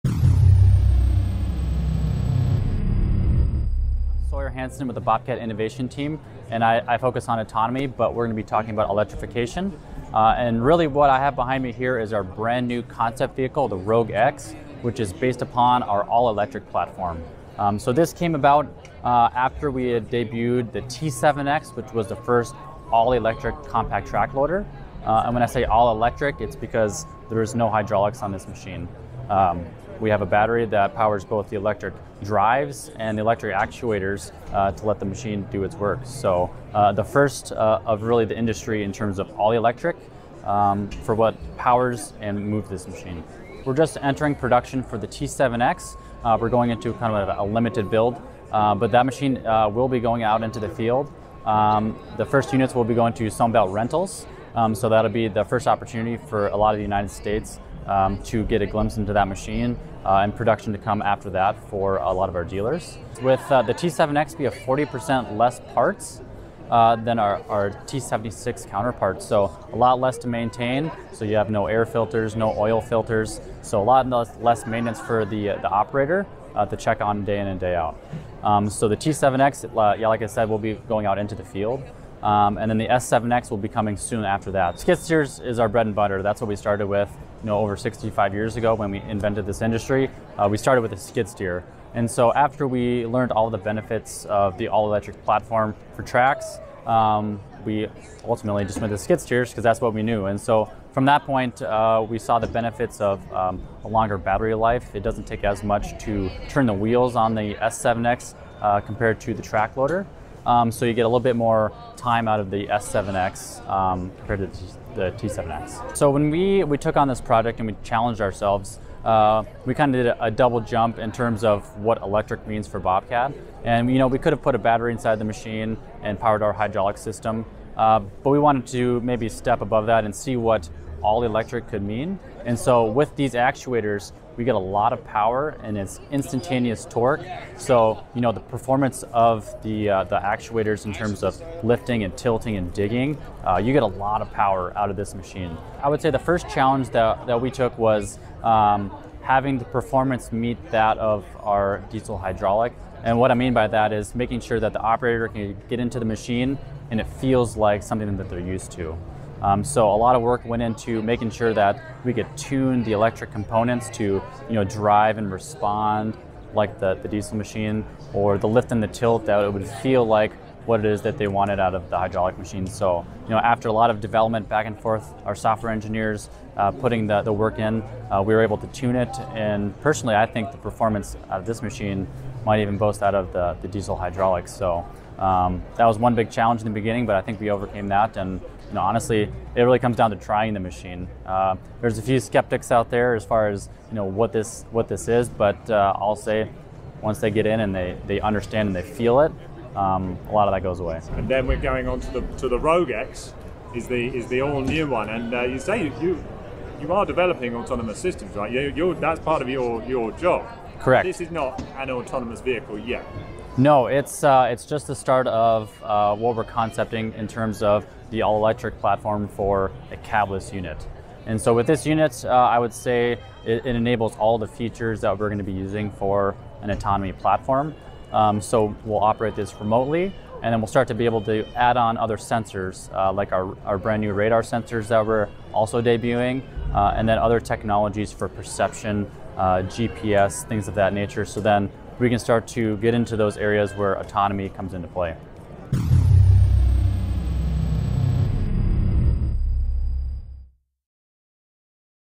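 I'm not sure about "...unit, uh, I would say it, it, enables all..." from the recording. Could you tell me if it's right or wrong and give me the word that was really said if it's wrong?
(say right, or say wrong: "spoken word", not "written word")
right.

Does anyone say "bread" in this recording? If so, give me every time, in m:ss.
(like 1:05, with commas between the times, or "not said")
1:25.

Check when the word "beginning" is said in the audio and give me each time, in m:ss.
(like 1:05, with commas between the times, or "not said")
3:06.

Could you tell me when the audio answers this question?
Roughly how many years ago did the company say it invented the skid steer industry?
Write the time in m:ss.
1:27.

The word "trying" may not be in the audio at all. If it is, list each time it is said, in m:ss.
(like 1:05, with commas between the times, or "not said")
3:10.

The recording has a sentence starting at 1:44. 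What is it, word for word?
It doesn't take as much to turn the wheels on the S7X uh, compared to the track loader.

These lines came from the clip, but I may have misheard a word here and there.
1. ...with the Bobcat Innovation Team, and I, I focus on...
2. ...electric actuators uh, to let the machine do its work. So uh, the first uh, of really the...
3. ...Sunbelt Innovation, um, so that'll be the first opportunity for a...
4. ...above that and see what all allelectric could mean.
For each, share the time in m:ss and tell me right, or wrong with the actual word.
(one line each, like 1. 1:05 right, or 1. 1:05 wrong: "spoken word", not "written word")
1. 0:04 right
2. 0:33 right
3. 0:53 wrong: "Rentals", not "Innovation"
4. 2:09 wrong: "electric", not "allelectric".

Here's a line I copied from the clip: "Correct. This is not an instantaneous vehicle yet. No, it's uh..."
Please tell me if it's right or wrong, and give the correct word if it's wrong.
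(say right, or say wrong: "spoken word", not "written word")
wrong: "autonomous", not "instantaneous".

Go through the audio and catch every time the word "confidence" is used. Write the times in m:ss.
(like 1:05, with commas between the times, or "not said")
not said.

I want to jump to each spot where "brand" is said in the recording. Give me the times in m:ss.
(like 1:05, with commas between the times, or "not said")
0:12, 3:53.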